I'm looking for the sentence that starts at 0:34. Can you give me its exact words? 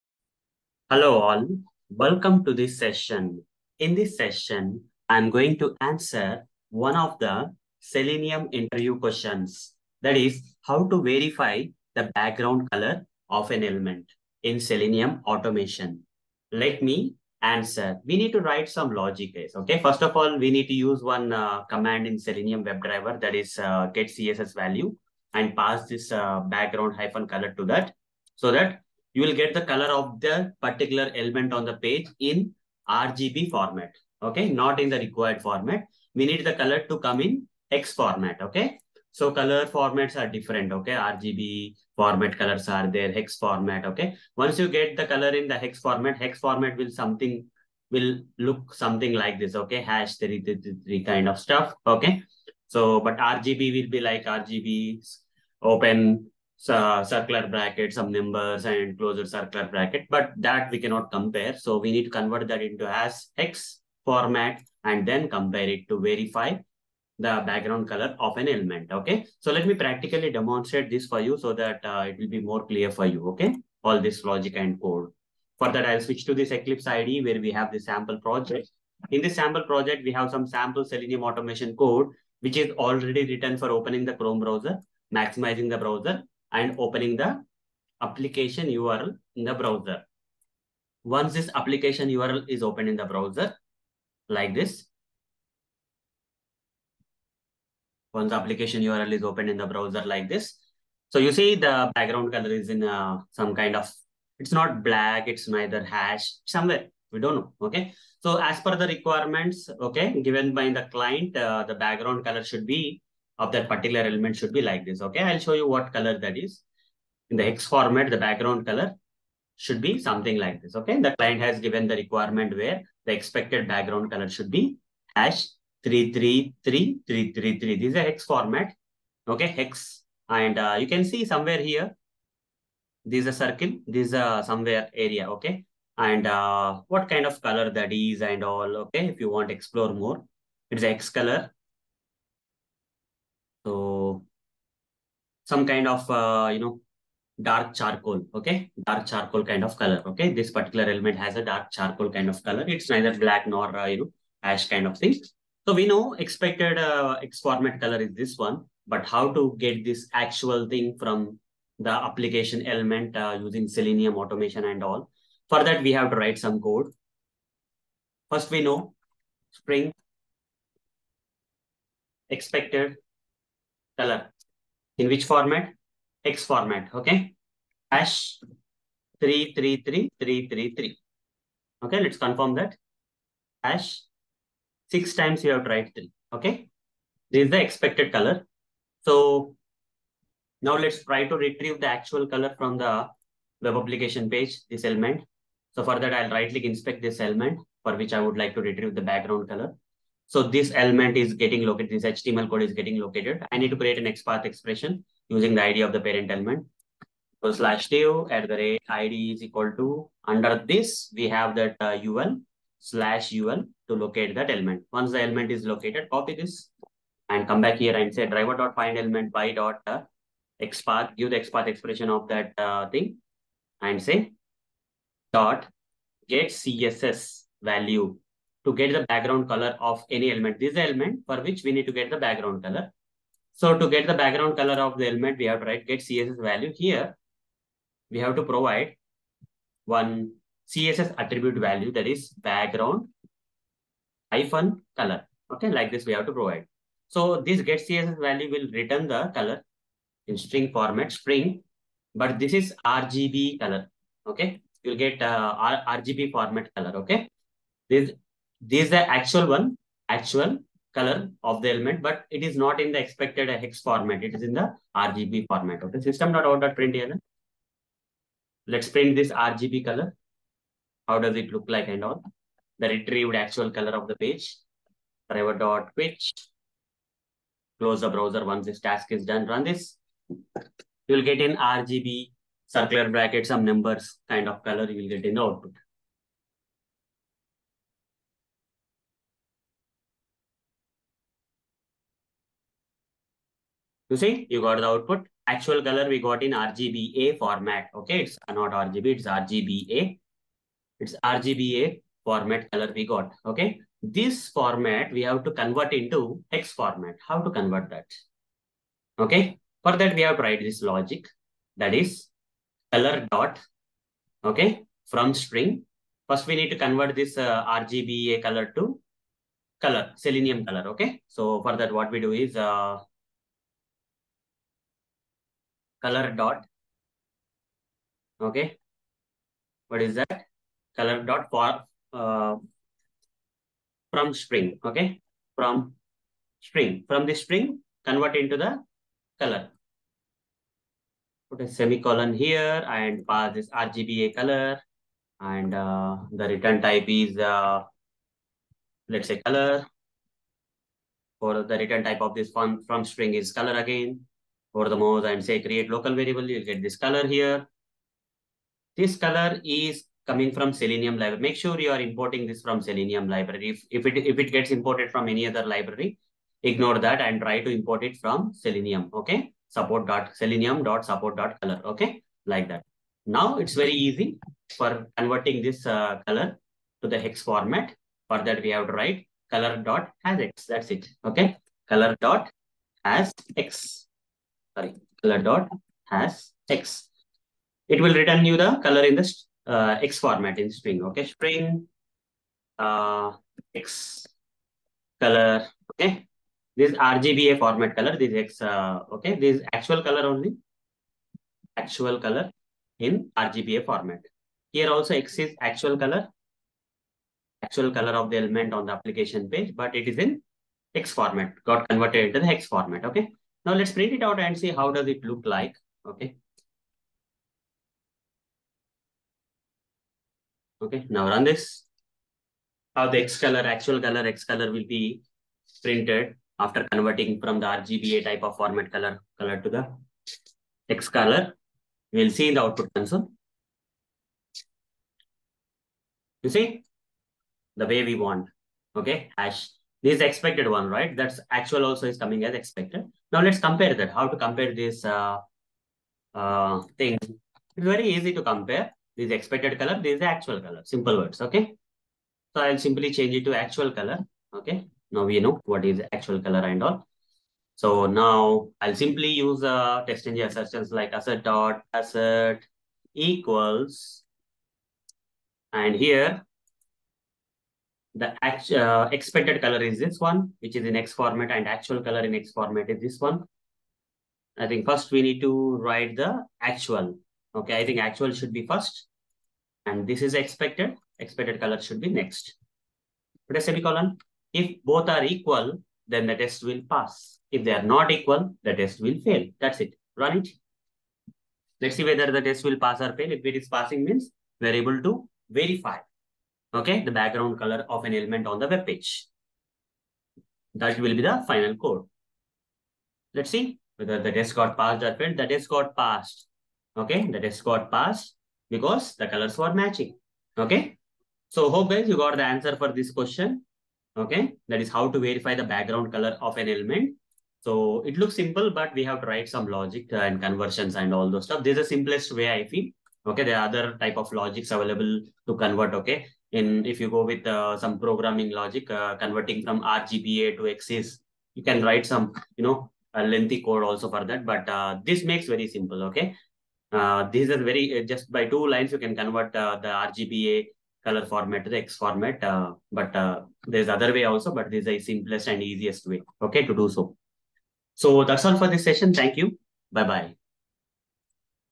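Okay, not in the required format.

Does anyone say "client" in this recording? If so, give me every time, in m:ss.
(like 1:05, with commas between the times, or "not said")
1:50, 2:01.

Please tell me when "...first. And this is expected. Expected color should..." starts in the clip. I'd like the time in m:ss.
7:58.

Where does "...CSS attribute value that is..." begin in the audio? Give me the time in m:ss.
4:00.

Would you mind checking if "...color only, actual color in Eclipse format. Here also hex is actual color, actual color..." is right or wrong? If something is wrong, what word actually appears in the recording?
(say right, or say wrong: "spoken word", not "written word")
wrong: "RGBA", not "Eclipse".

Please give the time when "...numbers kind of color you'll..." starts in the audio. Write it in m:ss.
4:43.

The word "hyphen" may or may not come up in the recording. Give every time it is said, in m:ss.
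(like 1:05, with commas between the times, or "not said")
0:26, 4:04.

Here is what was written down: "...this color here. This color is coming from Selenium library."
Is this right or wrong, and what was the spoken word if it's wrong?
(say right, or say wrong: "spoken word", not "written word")
right.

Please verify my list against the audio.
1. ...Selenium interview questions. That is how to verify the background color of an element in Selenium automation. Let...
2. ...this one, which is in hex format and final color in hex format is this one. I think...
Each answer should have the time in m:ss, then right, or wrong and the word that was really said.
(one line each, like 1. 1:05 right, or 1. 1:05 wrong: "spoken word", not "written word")
1. 0:07 right
2. 7:49 wrong: "actual", not "final".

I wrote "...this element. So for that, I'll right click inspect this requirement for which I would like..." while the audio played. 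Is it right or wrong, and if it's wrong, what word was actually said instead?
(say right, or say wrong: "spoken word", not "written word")
wrong: "element", not "requirement".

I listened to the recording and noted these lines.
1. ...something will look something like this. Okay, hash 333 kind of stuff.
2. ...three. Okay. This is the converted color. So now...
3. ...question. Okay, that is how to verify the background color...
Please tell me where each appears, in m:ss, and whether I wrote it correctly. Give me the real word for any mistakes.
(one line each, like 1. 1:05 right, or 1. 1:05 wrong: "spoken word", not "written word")
1. 0:46 right
2. 3:05 wrong: "expected", not "converted"
3. 8:33 right.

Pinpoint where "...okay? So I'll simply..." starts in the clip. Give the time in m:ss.
7:31.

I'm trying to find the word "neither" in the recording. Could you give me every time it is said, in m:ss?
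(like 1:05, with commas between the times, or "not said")
1:45, 2:32.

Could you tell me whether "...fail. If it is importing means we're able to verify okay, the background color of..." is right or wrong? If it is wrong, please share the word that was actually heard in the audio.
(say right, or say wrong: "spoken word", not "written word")
wrong: "passing", not "importing".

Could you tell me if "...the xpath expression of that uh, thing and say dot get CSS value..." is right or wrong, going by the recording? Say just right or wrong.
right.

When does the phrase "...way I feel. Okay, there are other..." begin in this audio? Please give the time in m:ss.
8:42.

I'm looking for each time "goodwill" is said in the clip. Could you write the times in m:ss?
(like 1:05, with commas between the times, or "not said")
not said.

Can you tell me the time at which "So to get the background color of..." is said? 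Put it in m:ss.
3:53.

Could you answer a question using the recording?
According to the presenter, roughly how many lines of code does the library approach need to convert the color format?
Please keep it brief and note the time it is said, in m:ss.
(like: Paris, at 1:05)
2, at 8:58.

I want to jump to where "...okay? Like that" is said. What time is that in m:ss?
6:11.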